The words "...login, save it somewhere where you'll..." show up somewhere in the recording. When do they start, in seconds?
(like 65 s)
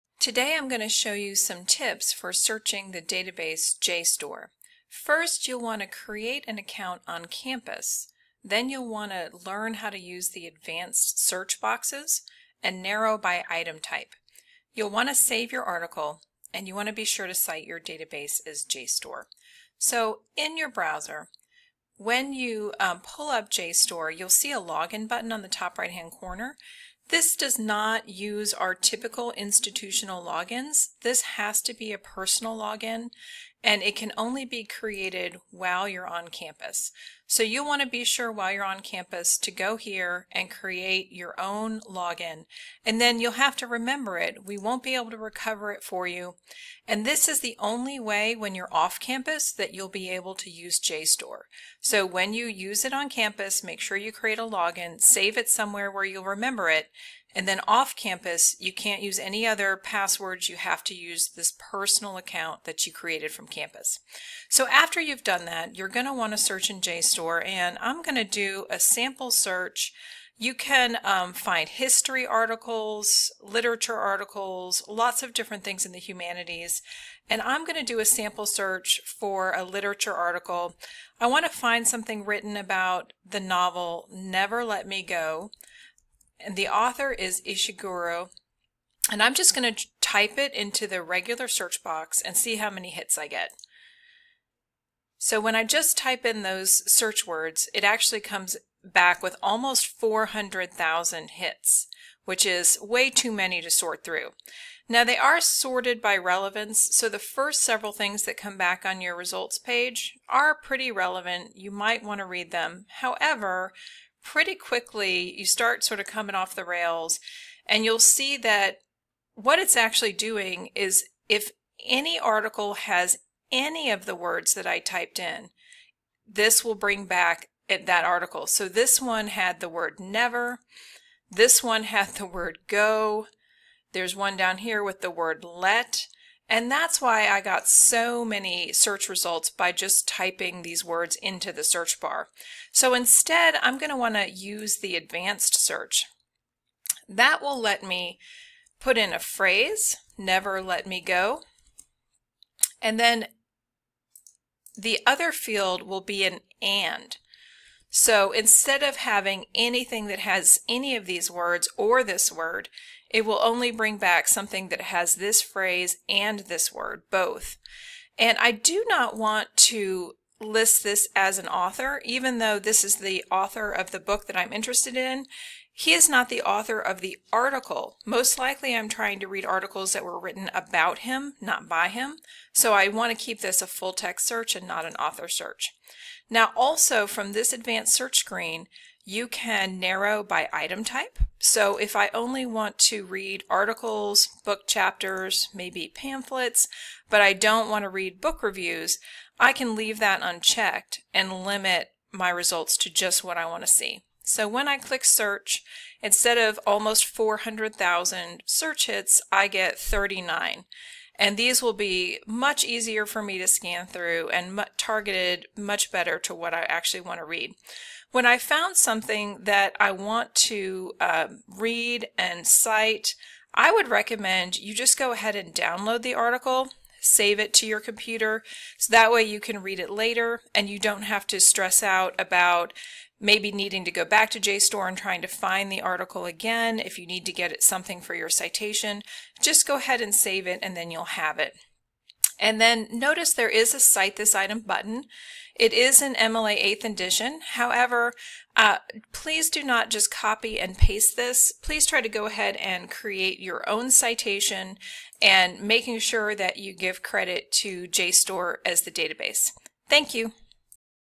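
54 s.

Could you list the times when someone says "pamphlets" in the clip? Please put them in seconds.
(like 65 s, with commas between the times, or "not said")
195 s.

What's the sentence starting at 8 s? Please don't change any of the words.
Then you'll want to learn how to use the advanced search boxes and narrow by item type.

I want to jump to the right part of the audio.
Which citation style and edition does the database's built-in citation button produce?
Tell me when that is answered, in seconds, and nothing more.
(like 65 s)
246 s.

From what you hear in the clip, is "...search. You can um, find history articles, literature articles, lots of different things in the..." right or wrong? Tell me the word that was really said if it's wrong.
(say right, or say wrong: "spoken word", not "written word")
right.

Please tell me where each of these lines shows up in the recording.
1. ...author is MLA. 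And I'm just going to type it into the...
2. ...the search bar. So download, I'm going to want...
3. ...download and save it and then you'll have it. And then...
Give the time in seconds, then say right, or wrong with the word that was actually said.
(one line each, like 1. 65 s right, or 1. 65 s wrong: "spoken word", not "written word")
1. 86 s wrong: "Ishiguro", not "MLA"
2. 141 s wrong: "instead", not "download"
3. 239 s wrong: "ahead", not "download".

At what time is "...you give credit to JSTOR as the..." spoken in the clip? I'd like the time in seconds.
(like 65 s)
256 s.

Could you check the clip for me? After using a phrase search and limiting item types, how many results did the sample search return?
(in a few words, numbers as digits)
39.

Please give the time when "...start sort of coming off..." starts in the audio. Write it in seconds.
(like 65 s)
115 s.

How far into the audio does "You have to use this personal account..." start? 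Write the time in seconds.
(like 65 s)
60 s.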